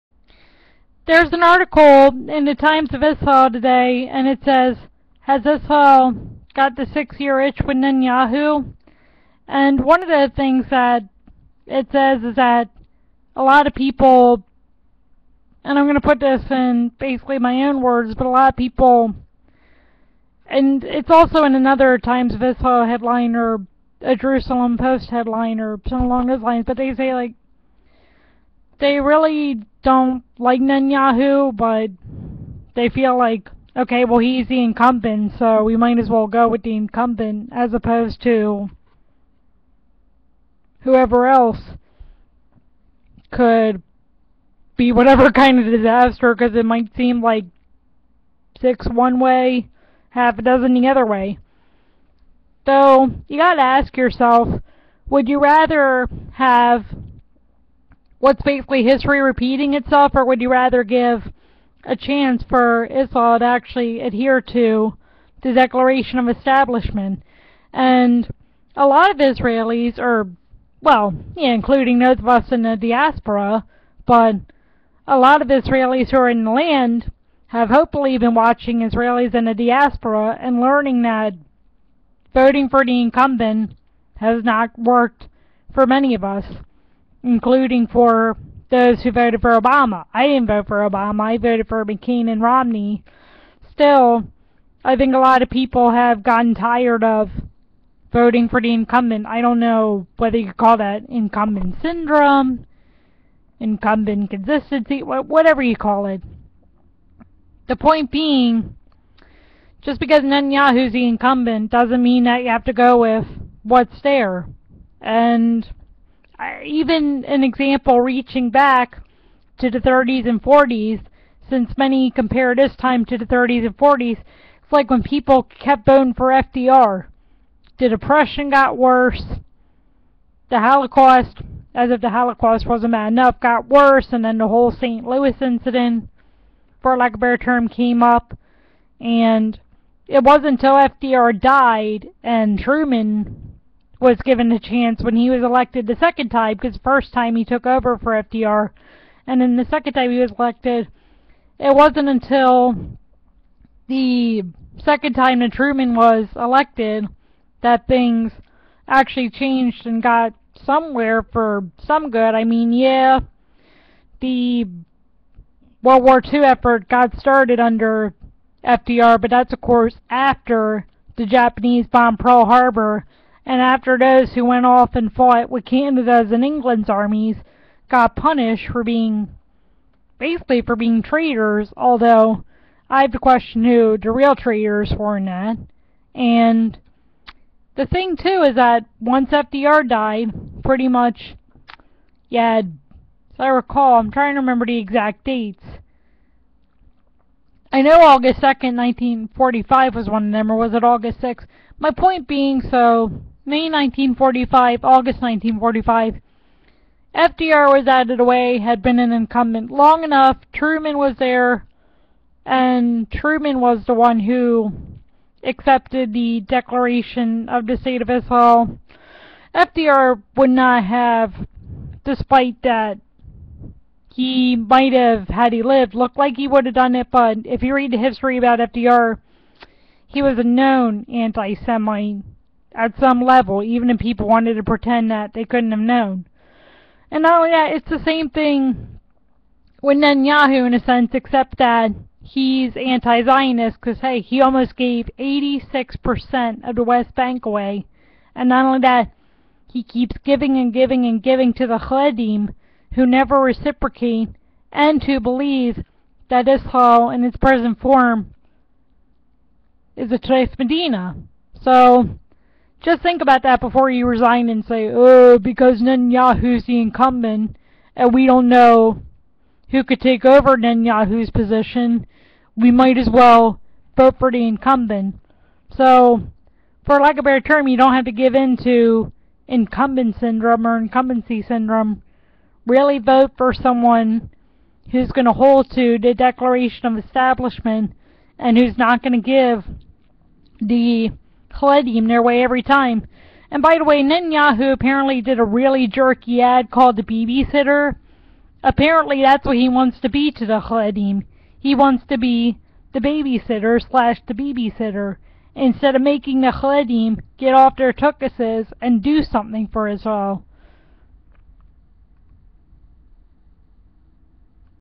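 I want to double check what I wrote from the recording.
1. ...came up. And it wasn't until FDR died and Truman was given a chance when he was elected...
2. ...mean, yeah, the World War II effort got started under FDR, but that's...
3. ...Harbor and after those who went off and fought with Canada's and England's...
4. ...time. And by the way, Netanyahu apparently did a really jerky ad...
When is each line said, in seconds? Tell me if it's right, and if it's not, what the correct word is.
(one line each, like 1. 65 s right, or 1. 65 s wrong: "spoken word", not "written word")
1. 137 s right
2. 162 s right
3. 172 s right
4. 292 s right.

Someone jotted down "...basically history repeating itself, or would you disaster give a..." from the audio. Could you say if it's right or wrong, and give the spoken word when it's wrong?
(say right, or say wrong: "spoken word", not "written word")
wrong: "rather", not "disaster".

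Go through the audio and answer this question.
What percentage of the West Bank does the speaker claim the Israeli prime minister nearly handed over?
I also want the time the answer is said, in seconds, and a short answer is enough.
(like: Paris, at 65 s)
86%, at 245 s.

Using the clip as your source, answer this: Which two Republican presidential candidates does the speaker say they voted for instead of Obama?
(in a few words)
McCain and Romney.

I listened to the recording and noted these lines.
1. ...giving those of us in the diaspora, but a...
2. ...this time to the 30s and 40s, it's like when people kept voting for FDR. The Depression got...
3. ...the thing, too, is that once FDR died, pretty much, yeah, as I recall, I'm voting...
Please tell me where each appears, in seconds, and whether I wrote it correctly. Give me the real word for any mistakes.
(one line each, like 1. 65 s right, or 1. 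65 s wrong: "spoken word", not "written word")
1. 71 s wrong: "including", not "giving"
2. 122 s right
3. 187 s wrong: "trying", not "voting".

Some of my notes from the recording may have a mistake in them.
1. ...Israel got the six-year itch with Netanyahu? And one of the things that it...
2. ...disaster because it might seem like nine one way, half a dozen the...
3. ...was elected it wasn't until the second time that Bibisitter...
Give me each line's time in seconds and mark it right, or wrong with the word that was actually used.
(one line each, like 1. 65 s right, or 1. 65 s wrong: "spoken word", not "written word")
1. 5 s right
2. 45 s wrong: "six", not "nine"
3. 150 s wrong: "Truman", not "Bibisitter".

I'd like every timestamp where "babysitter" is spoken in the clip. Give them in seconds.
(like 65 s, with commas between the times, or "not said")
304 s.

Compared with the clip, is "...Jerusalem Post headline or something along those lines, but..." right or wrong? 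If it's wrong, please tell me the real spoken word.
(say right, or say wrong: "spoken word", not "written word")
right.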